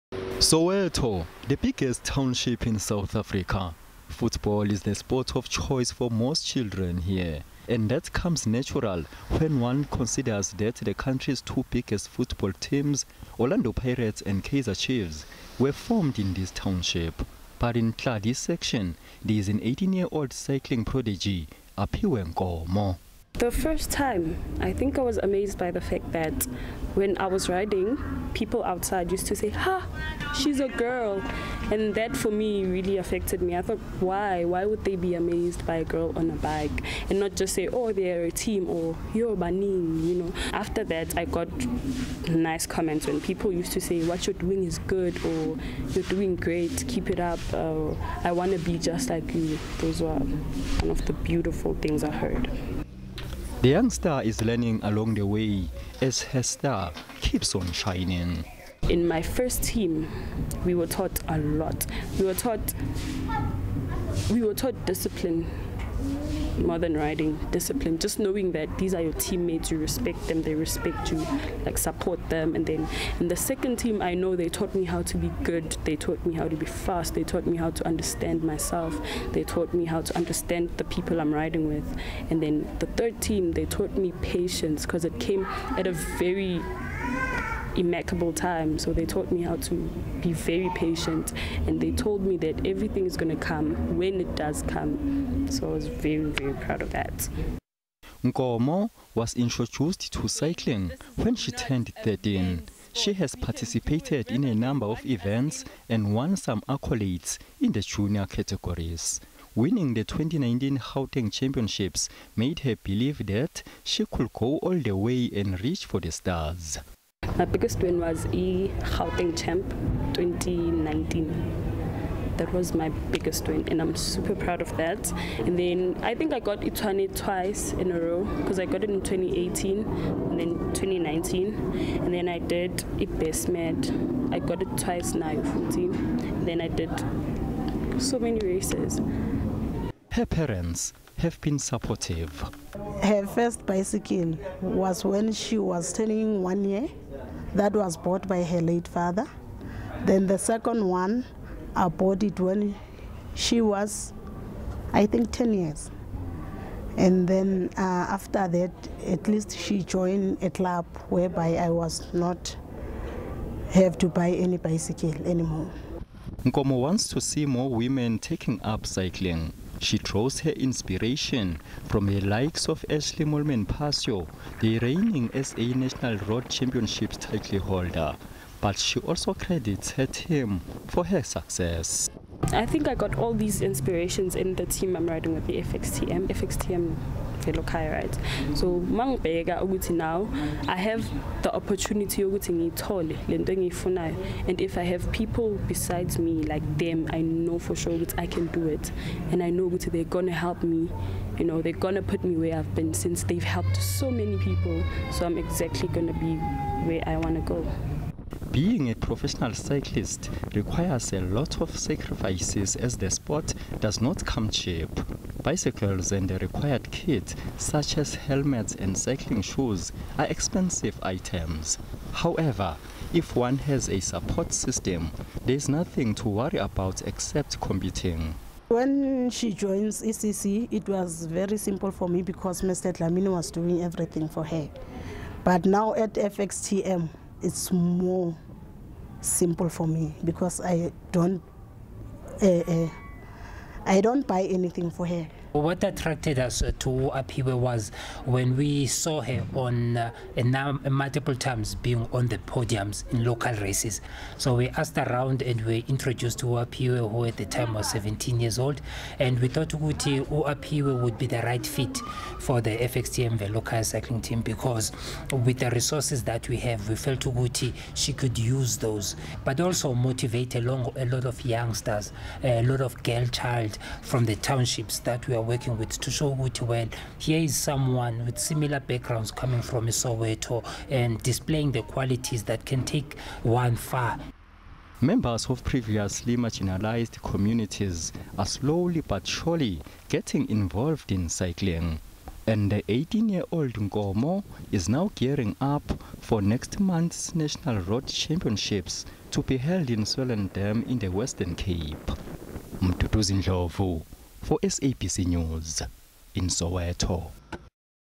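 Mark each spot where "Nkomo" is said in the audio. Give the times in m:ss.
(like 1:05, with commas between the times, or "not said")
0:22, 1:38, 2:46, 4:53.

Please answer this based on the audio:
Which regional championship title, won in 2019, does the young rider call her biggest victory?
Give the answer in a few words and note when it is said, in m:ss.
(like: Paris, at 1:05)
Gauteng Championships, at 1:50.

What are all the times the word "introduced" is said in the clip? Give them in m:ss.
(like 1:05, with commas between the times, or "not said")
1:39, 4:15.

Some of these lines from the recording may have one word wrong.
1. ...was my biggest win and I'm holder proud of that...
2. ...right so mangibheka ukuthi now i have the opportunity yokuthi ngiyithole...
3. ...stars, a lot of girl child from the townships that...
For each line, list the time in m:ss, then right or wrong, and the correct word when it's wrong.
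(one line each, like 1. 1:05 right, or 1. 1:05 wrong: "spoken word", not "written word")
1. 2:02 wrong: "super", not "holder"
2. 3:07 right
3. 4:31 wrong: "youngsters", not "stars".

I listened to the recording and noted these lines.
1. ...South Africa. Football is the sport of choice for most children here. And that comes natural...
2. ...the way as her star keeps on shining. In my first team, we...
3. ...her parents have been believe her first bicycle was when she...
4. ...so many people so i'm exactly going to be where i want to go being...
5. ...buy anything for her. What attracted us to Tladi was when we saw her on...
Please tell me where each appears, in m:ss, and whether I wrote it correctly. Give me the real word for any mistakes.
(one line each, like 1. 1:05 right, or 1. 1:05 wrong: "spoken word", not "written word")
1. 0:02 right
2. 0:55 right
3. 2:20 wrong: "supportive", not "believe"
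4. 3:23 right
5. 4:04 wrong: "Aphiwe", not "Tladi".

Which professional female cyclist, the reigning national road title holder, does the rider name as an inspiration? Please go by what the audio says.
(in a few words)
Ashleigh Moolman-Pasio.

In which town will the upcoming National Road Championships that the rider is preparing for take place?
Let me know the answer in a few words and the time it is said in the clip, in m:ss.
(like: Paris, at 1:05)
Swellendam, at 5:00.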